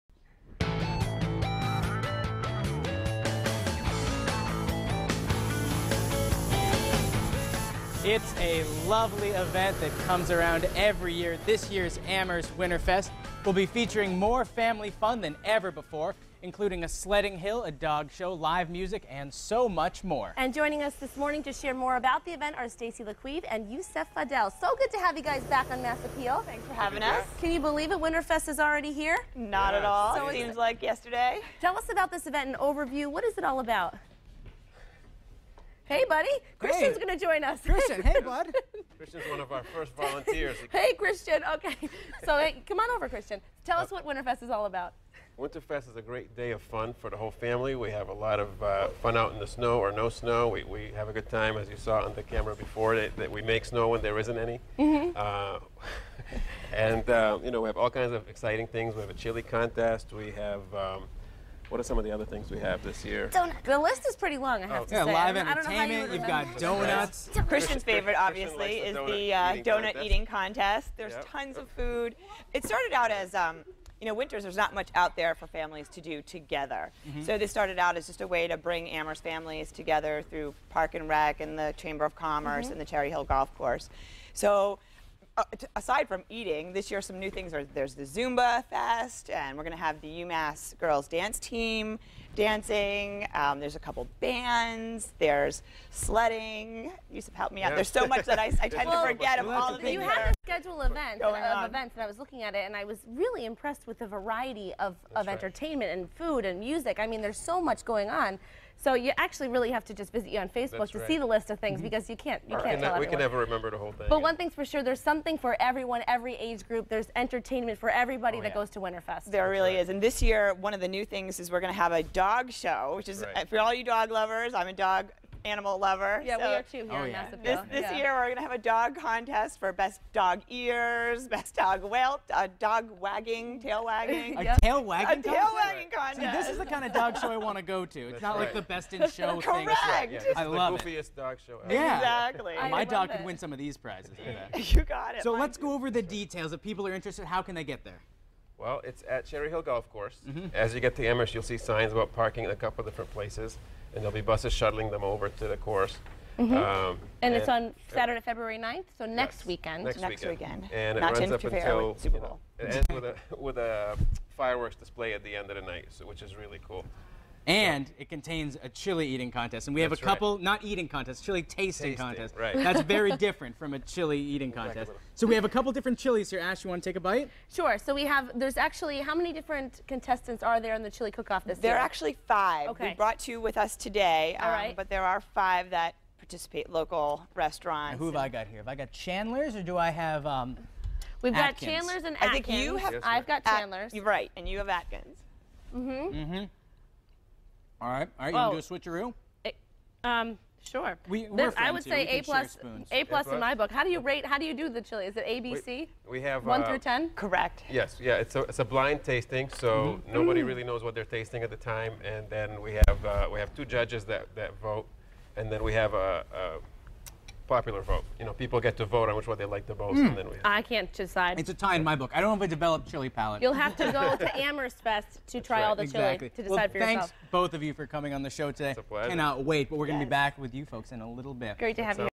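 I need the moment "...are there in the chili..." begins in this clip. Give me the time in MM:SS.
03:00.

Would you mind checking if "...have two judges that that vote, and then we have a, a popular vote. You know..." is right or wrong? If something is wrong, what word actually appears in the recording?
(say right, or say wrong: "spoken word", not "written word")
right.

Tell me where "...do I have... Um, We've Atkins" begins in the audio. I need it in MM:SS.
03:09.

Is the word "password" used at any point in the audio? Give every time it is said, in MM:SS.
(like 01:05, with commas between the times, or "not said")
not said.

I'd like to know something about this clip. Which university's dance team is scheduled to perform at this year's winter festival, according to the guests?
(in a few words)
UMass.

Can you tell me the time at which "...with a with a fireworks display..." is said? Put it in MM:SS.
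02:42.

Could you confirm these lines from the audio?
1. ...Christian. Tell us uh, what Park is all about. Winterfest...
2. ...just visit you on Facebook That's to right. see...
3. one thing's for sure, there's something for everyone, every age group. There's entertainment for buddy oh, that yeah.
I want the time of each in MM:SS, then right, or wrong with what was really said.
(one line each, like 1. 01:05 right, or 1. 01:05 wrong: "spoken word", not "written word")
1. 00:43 wrong: "Winterfest", not "Park"
2. 01:49 right
3. 01:54 wrong: "everybody", not "buddy".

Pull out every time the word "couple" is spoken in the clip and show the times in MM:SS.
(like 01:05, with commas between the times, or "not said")
01:33, 02:32, 02:50, 02:55.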